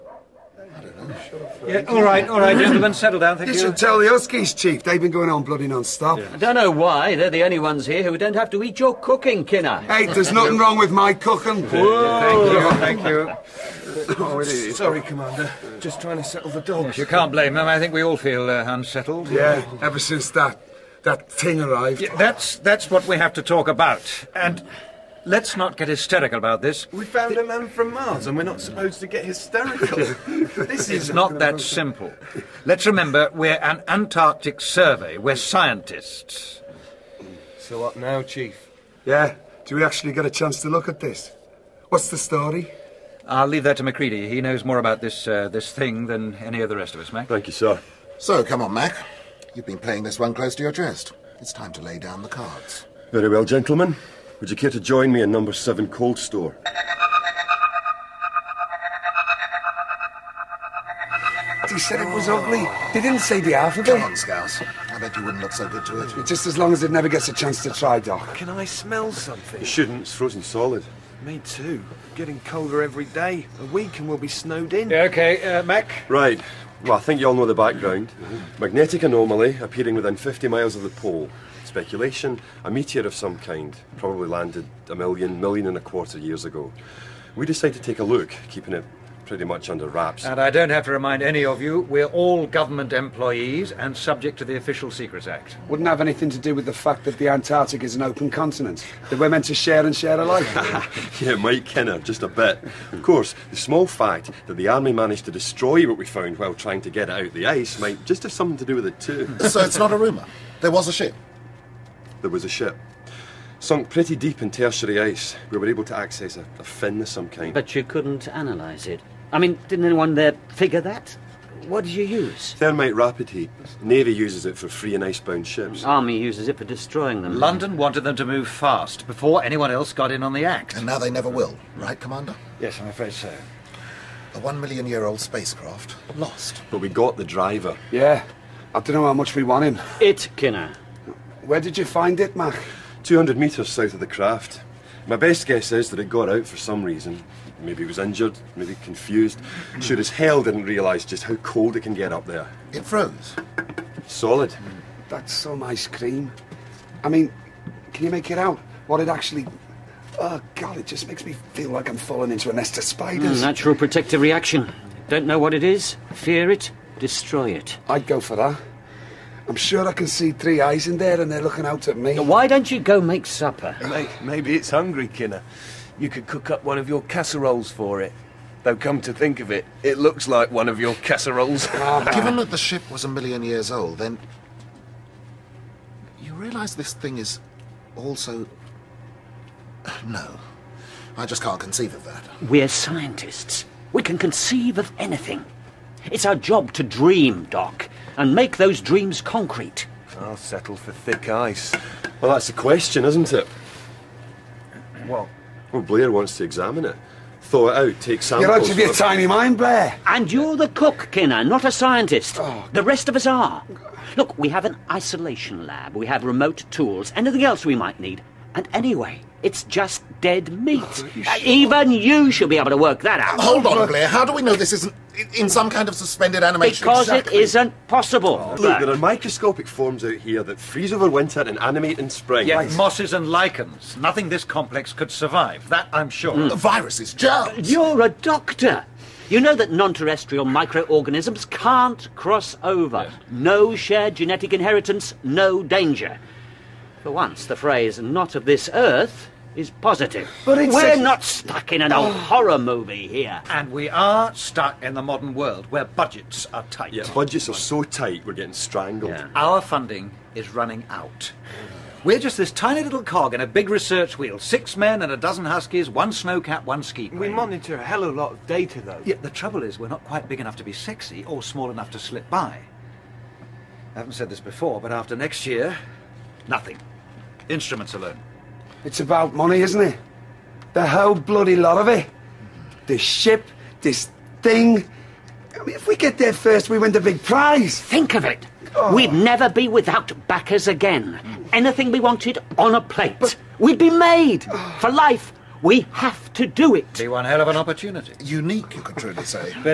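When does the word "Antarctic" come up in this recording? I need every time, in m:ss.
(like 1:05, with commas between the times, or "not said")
0:33, 1:37.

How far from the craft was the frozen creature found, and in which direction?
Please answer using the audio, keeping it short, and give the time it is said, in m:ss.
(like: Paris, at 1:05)
200 metres south, at 2:23.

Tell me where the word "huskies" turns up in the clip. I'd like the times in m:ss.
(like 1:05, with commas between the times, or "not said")
0:04, 4:25.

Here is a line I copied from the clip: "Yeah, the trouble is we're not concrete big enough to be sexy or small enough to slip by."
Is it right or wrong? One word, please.
wrong.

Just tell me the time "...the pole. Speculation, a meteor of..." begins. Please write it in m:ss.
1:20.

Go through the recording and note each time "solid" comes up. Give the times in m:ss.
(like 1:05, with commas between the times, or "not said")
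1:10, 2:34.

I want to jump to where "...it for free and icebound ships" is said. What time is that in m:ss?
2:04.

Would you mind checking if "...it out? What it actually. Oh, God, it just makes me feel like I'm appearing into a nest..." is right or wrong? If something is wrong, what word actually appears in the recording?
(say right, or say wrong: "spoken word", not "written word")
wrong: "falling", not "appearing".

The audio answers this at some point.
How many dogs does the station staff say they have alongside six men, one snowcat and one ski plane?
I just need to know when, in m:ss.
4:25.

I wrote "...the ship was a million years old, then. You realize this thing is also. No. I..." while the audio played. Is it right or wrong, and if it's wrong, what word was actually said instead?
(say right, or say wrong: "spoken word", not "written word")
right.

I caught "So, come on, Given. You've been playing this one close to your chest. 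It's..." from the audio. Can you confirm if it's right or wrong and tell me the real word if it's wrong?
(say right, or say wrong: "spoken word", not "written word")
wrong: "Mac", not "Given".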